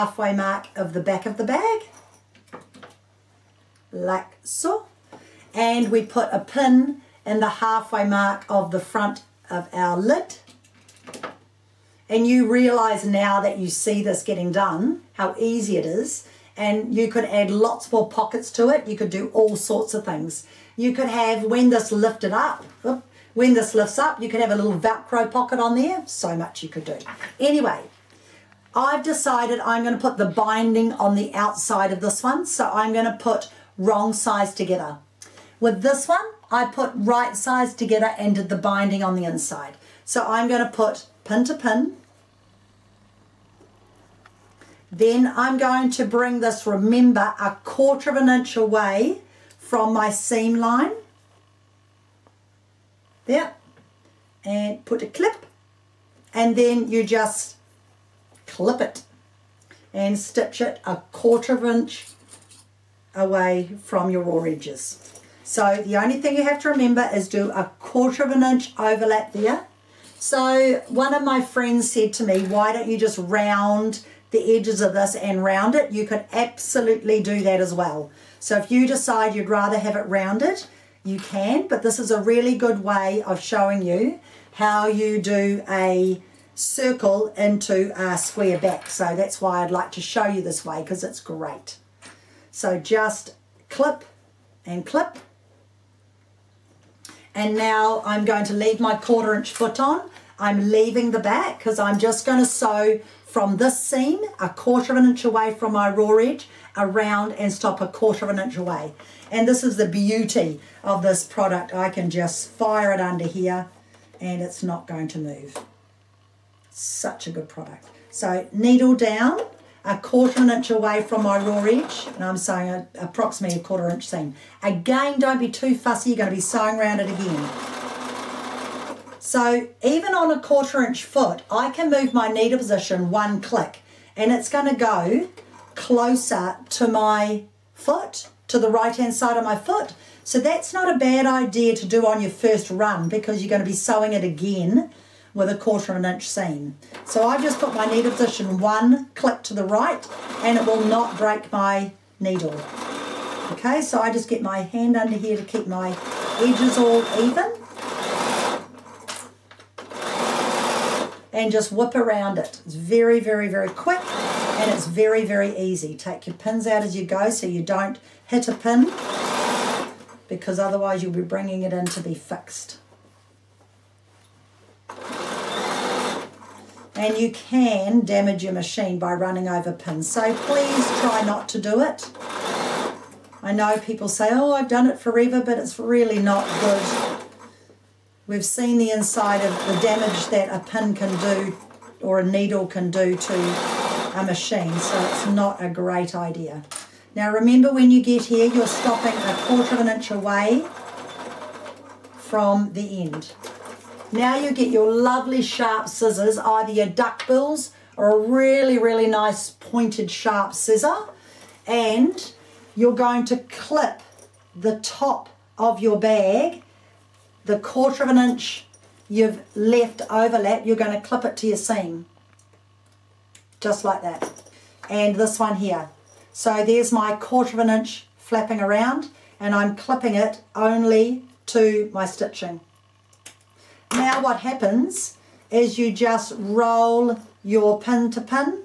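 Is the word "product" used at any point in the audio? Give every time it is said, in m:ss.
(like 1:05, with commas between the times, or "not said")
1:51, 1:57.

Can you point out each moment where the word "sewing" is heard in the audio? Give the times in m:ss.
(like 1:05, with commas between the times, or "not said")
2:02, 2:06, 2:23.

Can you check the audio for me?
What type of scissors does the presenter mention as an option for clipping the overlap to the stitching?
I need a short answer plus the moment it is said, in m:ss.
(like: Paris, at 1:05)
Duck bills, at 3:26.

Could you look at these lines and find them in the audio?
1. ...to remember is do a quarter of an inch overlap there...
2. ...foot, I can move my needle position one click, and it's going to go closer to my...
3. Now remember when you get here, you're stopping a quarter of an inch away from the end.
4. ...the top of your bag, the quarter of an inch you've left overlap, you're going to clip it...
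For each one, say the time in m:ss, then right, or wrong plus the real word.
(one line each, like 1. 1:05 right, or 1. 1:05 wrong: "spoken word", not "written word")
1. 1:06 right
2. 2:11 right
3. 3:17 right
4. 3:34 right.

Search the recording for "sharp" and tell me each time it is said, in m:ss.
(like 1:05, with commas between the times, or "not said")
3:25, 3:30.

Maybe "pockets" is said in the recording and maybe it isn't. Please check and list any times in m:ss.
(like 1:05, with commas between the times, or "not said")
0:18, 0:25.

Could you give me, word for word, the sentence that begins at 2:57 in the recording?
and you can damage your machine by running over pins.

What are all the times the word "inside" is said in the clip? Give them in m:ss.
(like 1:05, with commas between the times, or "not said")
0:39, 3:08.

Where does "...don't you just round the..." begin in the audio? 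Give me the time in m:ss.
1:12.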